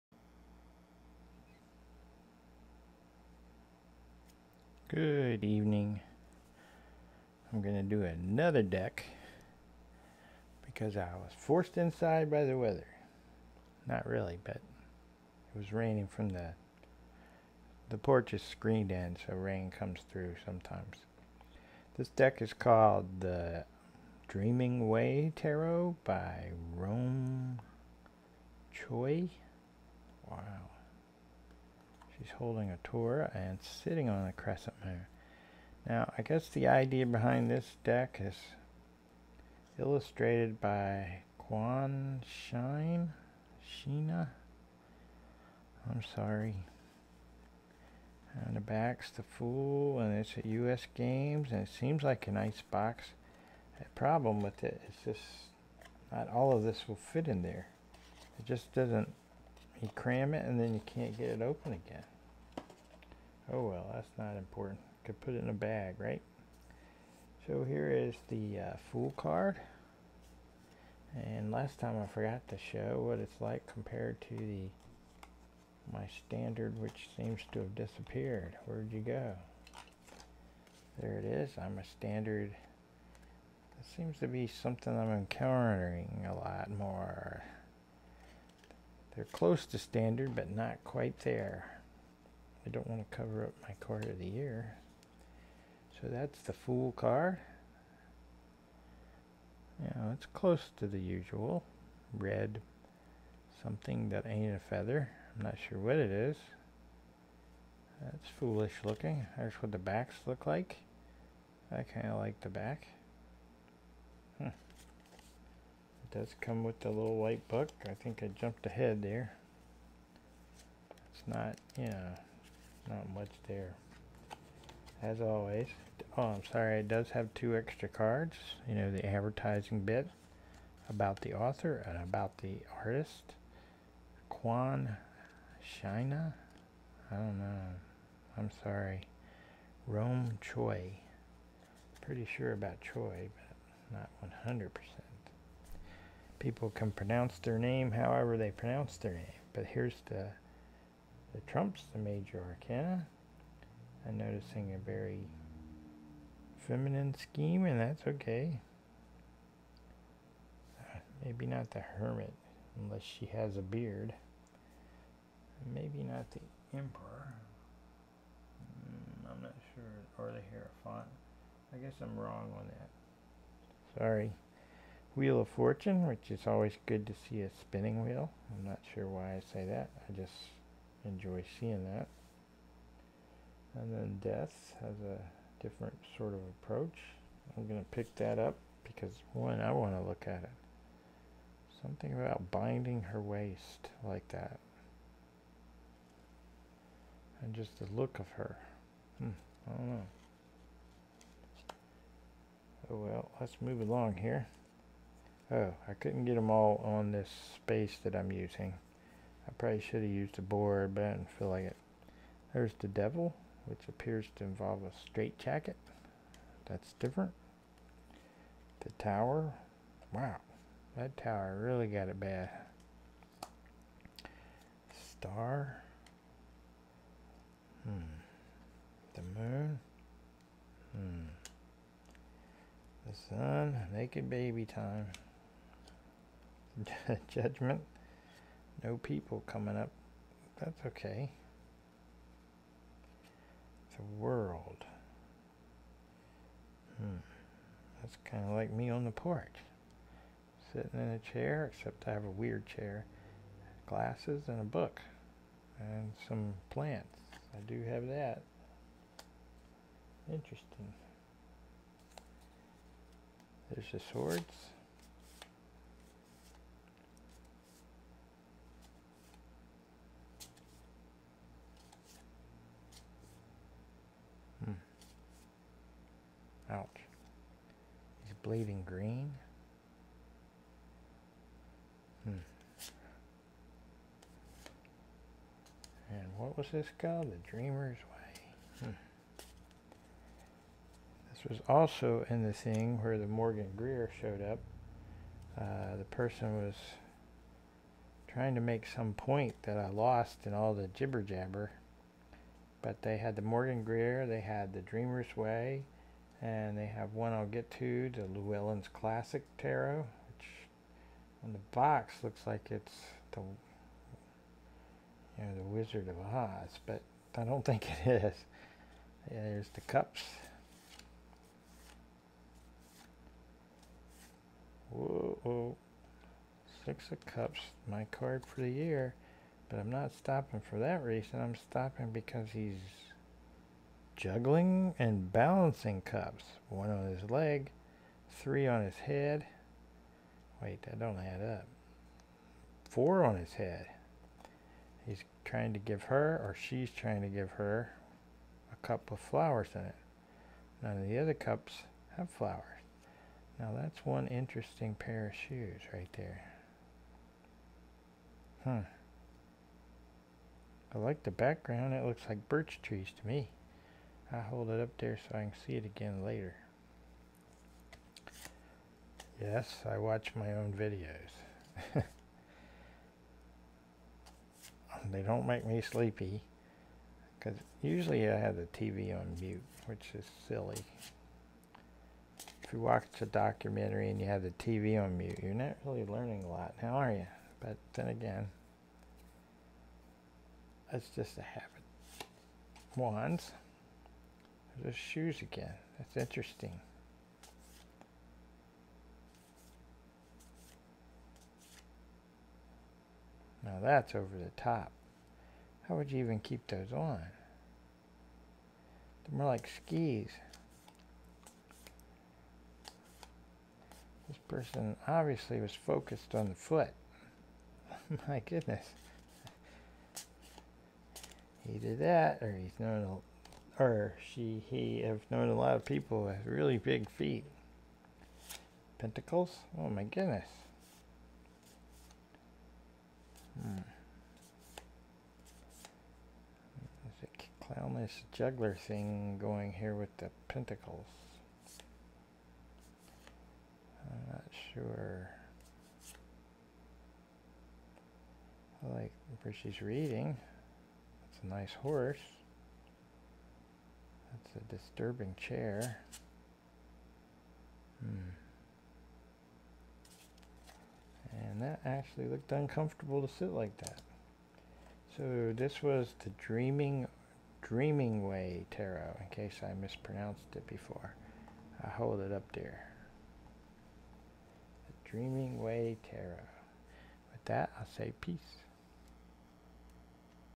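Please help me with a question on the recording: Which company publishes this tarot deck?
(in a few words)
U.S. Games.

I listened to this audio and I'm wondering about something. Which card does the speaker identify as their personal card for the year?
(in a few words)
Six of Cups.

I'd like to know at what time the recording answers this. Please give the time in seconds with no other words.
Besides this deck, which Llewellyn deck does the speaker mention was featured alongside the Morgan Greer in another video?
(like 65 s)
308 s.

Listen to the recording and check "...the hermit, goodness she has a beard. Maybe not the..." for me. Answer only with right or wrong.
wrong.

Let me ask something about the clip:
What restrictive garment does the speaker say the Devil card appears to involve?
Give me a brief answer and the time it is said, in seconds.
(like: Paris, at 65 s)
A straitjacket, at 215 s.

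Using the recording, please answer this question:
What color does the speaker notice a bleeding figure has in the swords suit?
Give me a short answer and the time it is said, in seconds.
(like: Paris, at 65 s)
Green, at 278 s.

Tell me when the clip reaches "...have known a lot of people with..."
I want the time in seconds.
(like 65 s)
425 s.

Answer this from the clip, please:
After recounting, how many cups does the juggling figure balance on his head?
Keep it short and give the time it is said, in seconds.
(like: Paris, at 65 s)
4, at 342 s.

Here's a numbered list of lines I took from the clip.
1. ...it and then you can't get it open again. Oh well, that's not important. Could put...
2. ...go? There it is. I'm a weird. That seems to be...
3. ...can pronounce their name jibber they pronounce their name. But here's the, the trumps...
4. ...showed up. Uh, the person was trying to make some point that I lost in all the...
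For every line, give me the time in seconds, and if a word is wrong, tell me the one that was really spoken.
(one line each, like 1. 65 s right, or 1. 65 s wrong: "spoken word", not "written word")
1. 60 s right
2. 79 s wrong: "standard", not "weird"
3. 146 s wrong: "however", not "jibber"
4. 294 s right.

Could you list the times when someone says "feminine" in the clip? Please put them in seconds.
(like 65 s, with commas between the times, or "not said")
156 s.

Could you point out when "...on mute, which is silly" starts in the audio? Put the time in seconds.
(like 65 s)
379 s.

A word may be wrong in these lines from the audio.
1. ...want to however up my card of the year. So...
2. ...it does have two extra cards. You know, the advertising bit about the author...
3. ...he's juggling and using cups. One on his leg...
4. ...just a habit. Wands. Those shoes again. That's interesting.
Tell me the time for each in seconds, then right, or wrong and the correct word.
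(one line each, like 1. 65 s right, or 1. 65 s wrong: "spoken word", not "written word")
1. 92 s wrong: "cover", not "however"
2. 126 s right
3. 332 s wrong: "balancing", not "using"
4. 391 s right.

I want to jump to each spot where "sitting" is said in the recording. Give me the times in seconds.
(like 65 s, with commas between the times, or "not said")
33 s, 250 s.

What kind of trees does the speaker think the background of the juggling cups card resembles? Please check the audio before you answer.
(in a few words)
Birch trees.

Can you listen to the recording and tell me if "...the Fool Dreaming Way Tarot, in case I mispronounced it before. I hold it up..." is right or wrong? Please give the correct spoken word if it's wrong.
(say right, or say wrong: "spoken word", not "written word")
wrong: "Dreaming", not "Fool".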